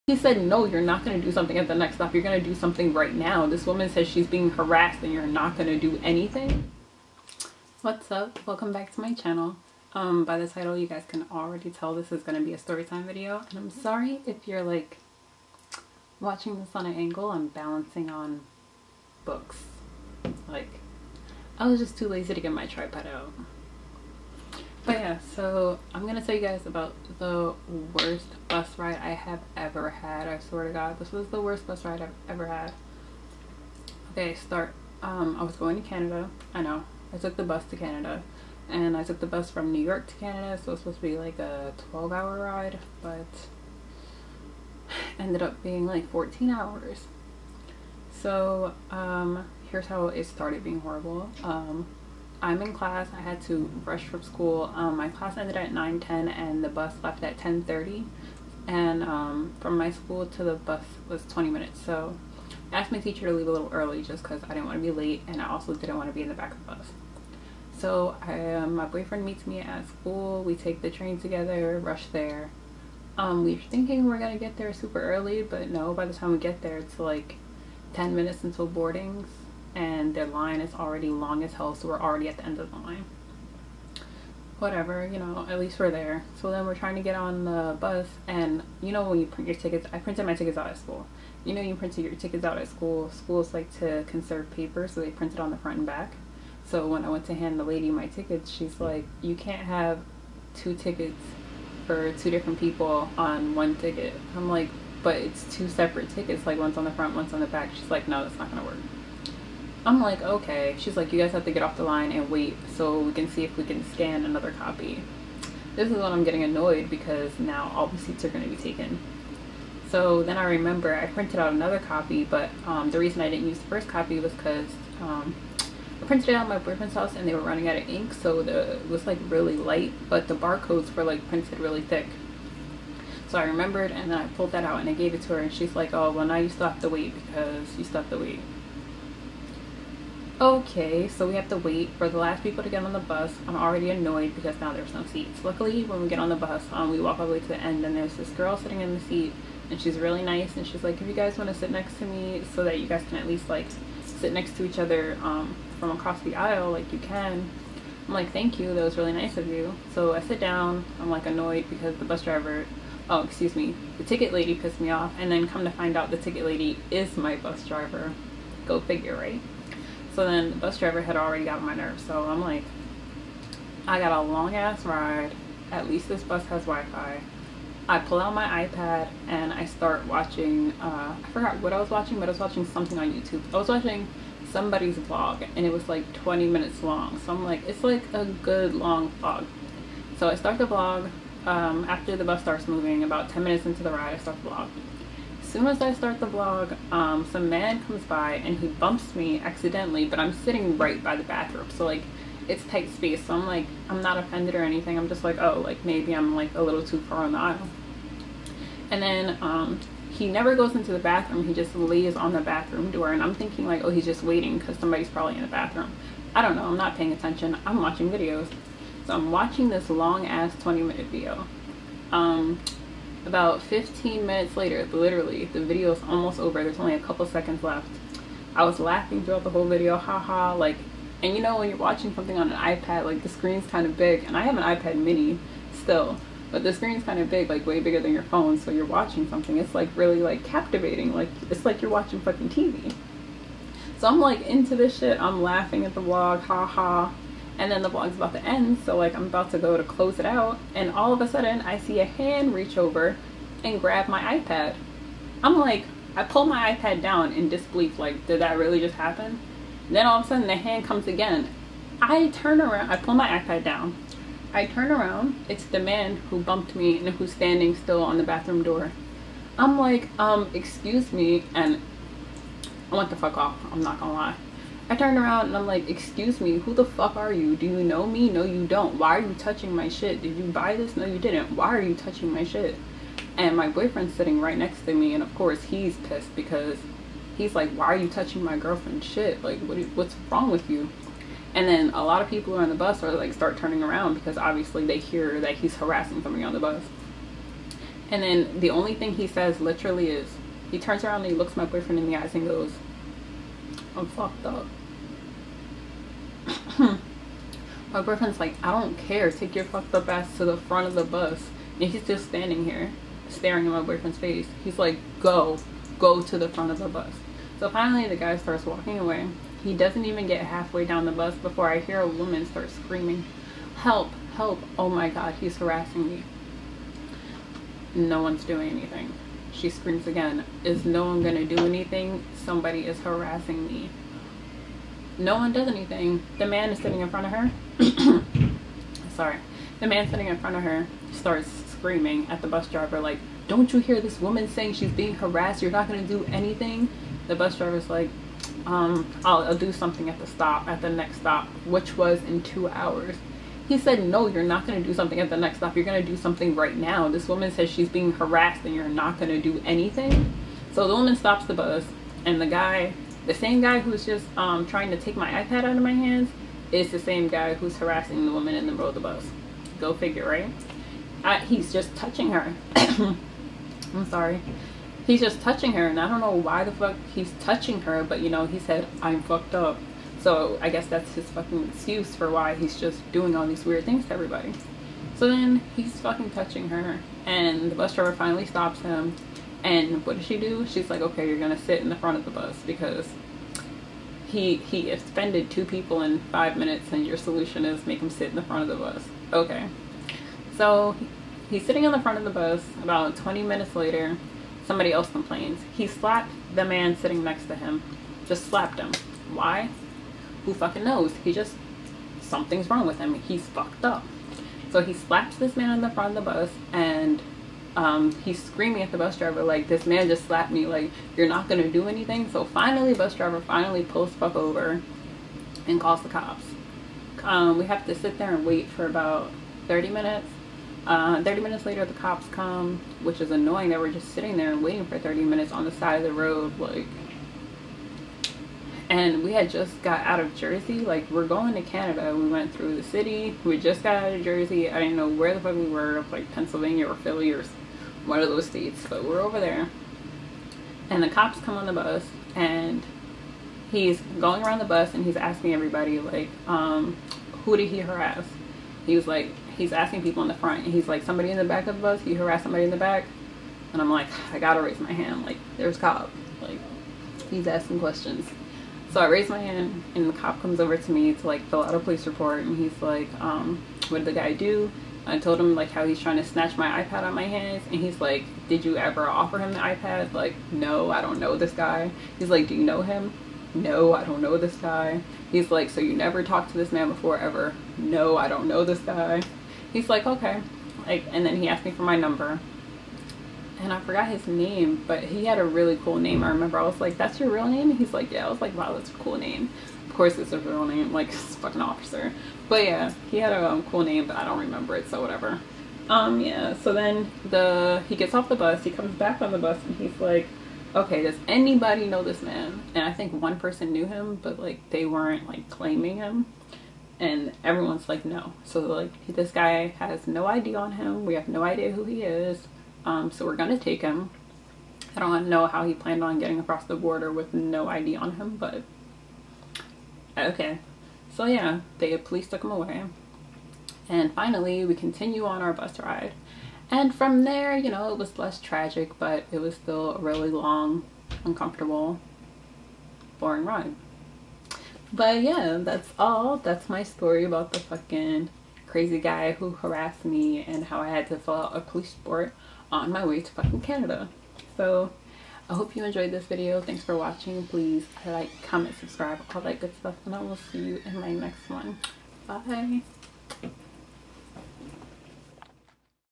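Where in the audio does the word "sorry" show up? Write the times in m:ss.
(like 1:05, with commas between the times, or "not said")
0:13, 5:39, 6:14.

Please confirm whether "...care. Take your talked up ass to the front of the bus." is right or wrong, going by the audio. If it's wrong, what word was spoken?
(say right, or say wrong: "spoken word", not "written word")
wrong: "fucked", not "talked".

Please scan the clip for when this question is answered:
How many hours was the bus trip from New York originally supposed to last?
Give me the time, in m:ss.
0:41.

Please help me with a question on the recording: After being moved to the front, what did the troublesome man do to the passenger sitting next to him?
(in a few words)
Slapped him.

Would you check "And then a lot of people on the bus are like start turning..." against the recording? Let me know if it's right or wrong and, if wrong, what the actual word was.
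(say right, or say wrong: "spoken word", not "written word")
right.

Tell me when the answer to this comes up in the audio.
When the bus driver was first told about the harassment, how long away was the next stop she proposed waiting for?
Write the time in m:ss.
5:51.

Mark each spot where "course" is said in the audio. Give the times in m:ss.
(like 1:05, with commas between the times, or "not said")
4:45, 8:19.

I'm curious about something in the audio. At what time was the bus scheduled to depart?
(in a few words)
10:30.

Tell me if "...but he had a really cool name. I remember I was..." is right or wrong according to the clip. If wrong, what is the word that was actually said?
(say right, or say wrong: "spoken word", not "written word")
right.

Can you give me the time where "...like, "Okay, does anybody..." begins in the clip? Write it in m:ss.
8:29.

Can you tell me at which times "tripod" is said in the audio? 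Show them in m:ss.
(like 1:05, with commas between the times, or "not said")
0:22.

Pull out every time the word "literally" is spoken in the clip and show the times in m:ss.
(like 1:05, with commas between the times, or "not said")
3:44, 4:59.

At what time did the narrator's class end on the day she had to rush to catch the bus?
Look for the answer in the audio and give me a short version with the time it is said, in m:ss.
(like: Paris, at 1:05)
9:10, at 0:55.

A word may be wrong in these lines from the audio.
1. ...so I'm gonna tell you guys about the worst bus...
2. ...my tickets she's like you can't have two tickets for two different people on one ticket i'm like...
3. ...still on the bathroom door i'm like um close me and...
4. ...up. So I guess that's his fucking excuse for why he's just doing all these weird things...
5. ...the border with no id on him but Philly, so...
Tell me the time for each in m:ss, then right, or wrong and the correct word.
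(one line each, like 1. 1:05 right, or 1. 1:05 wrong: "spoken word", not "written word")
1. 0:25 right
2. 1:37 right
3. 4:27 wrong: "excuse", not "close"
4. 6:19 right
5. 8:46 wrong: "Okay", not "Philly".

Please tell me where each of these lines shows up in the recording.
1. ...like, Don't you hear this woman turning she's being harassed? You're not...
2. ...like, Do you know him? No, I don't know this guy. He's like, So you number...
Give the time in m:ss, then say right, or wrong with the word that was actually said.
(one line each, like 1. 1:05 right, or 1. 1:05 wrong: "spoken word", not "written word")
1. 5:42 wrong: "saying", not "turning"
2. 8:02 wrong: "never", not "number".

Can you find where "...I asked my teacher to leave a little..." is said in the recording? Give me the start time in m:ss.
1:02.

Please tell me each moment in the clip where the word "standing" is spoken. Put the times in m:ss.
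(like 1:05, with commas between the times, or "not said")
4:27, 5:12.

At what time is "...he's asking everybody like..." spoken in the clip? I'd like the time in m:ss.
7:35.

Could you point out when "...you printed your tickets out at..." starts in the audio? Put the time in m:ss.
1:31.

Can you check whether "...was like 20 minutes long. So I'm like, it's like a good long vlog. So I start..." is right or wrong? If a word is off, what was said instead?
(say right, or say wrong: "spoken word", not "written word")
right.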